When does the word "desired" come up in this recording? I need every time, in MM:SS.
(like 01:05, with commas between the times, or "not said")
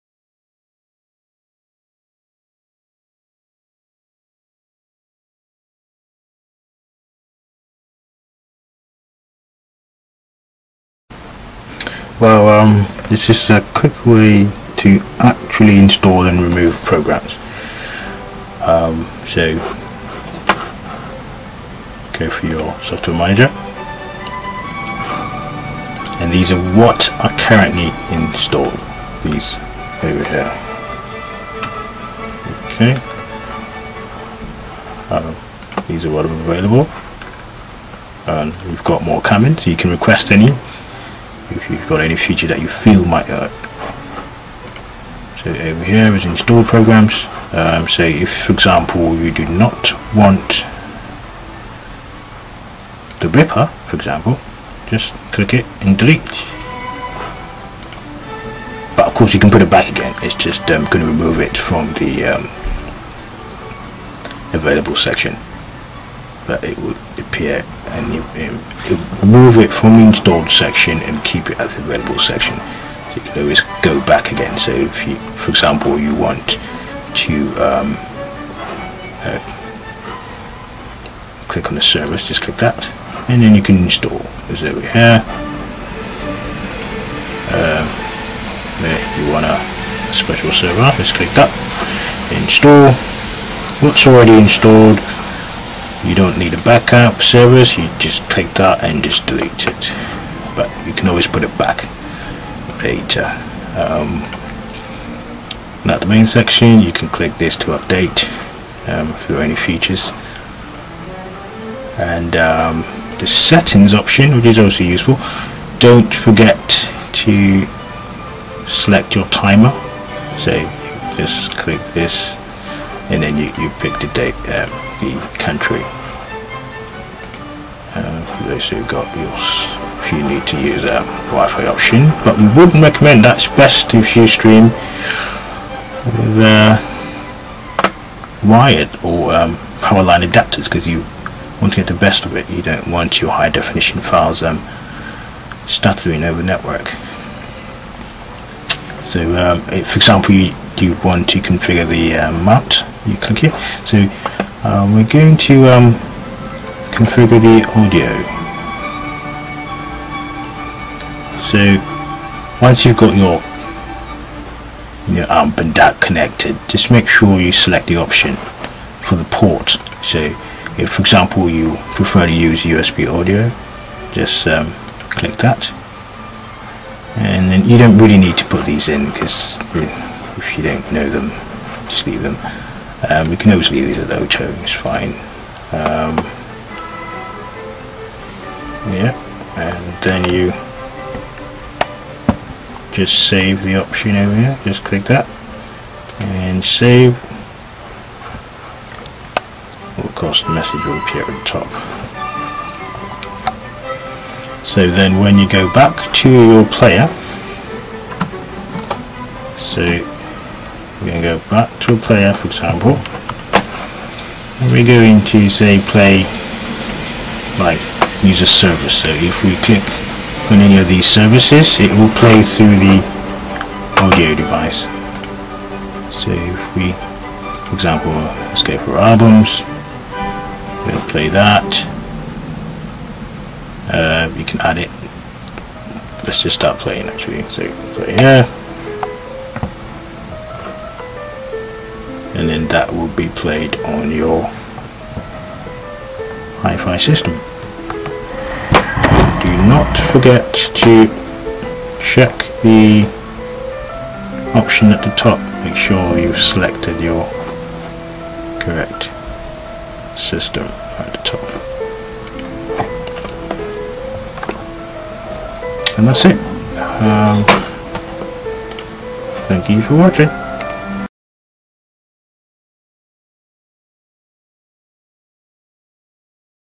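not said.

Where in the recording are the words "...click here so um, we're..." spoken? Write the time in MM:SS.
02:33.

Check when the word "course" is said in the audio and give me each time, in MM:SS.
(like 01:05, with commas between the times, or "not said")
00:59, 03:20.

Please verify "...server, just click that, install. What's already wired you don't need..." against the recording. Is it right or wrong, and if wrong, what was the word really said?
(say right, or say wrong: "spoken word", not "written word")
wrong: "installed", not "wired".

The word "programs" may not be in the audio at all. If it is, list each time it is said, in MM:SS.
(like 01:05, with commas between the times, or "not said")
00:16, 00:46.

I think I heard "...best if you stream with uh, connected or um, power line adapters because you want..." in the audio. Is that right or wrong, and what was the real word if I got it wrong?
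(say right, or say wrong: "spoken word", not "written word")
wrong: "wired", not "connected".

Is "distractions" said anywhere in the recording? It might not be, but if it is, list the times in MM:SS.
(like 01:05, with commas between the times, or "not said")
not said.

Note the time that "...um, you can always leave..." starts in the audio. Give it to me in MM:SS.
03:03.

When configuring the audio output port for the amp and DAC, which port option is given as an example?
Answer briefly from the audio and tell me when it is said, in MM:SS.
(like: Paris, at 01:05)
USB audio, at 02:52.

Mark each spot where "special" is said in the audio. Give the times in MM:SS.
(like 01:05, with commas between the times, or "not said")
01:30.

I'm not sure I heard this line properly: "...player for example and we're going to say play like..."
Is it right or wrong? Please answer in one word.
right.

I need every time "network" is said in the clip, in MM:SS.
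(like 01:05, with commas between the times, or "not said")
02:26.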